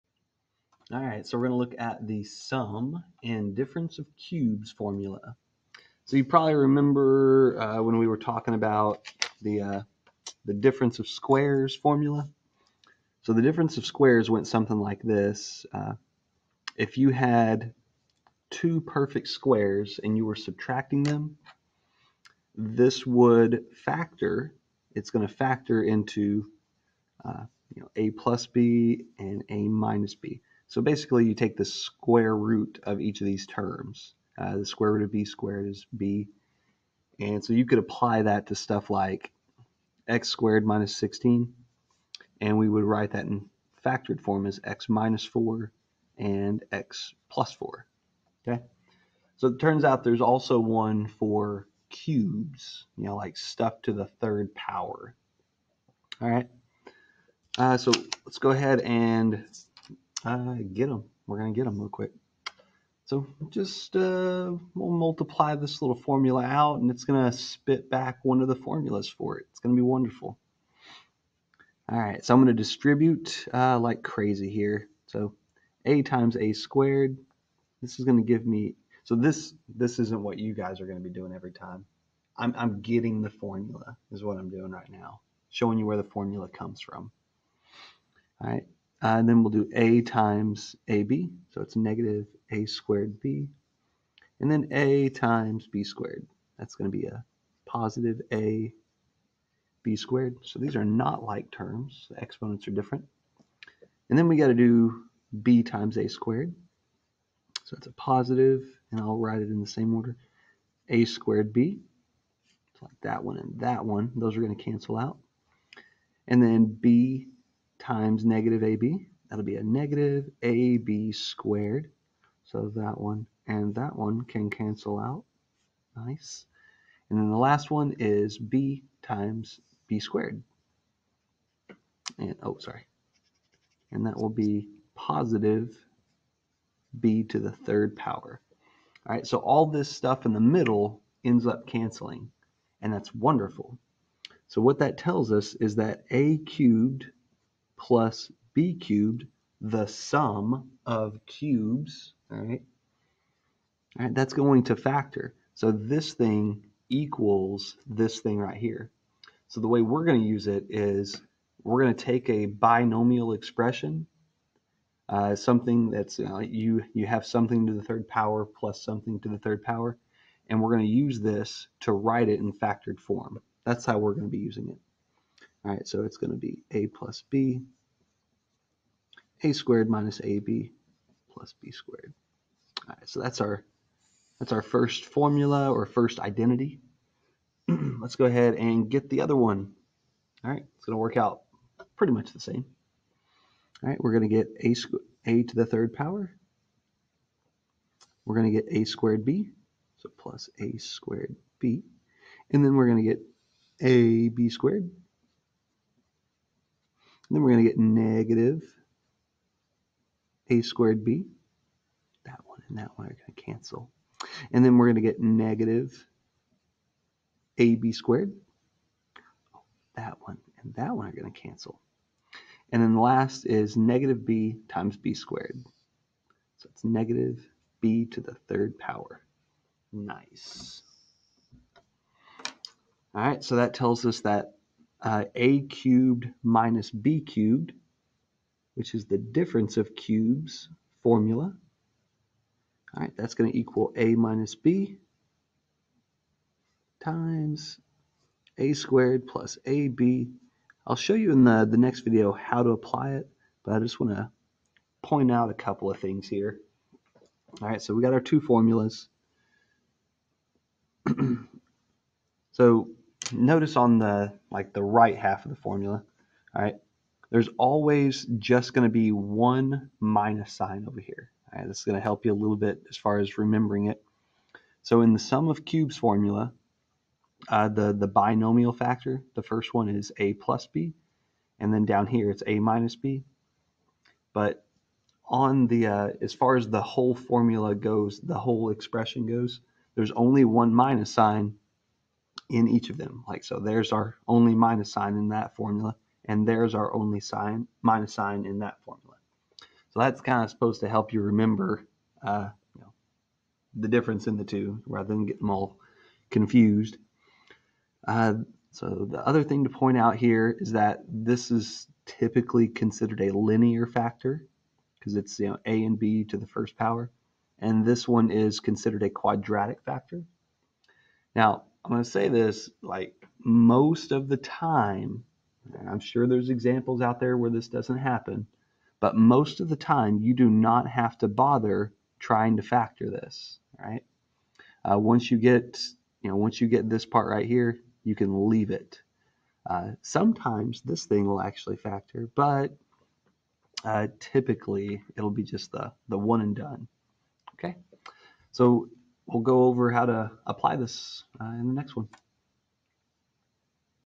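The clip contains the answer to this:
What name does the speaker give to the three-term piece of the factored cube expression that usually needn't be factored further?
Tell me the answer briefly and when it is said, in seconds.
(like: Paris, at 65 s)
quadratic factor, at 319 s.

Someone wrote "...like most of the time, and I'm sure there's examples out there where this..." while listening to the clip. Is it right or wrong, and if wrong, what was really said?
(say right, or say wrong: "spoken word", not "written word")
right.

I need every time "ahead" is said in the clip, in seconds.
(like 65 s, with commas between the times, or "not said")
58 s, 188 s.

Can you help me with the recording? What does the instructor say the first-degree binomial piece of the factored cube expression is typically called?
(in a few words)
linear factor.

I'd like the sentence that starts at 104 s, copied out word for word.
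And then we got to do b times a squared.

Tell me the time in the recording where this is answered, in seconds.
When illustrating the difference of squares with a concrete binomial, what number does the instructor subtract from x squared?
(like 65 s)
40 s.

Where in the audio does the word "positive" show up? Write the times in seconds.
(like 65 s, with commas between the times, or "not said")
97 s, 107 s, 134 s.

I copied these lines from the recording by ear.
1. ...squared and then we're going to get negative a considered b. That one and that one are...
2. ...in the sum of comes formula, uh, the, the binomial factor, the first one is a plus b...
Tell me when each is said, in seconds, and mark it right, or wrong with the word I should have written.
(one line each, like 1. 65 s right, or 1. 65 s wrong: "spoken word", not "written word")
1. 204 s wrong: "squared", not "considered"
2. 275 s wrong: "cubes", not "comes".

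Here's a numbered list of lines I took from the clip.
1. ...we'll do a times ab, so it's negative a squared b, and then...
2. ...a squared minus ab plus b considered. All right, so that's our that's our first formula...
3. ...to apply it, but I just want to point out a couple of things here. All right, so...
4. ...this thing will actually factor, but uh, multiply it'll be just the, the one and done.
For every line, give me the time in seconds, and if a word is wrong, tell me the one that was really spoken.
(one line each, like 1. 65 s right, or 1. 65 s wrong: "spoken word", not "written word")
1. 89 s right
2. 179 s wrong: "squared", not "considered"
3. 252 s right
4. 340 s wrong: "typically", not "multiply".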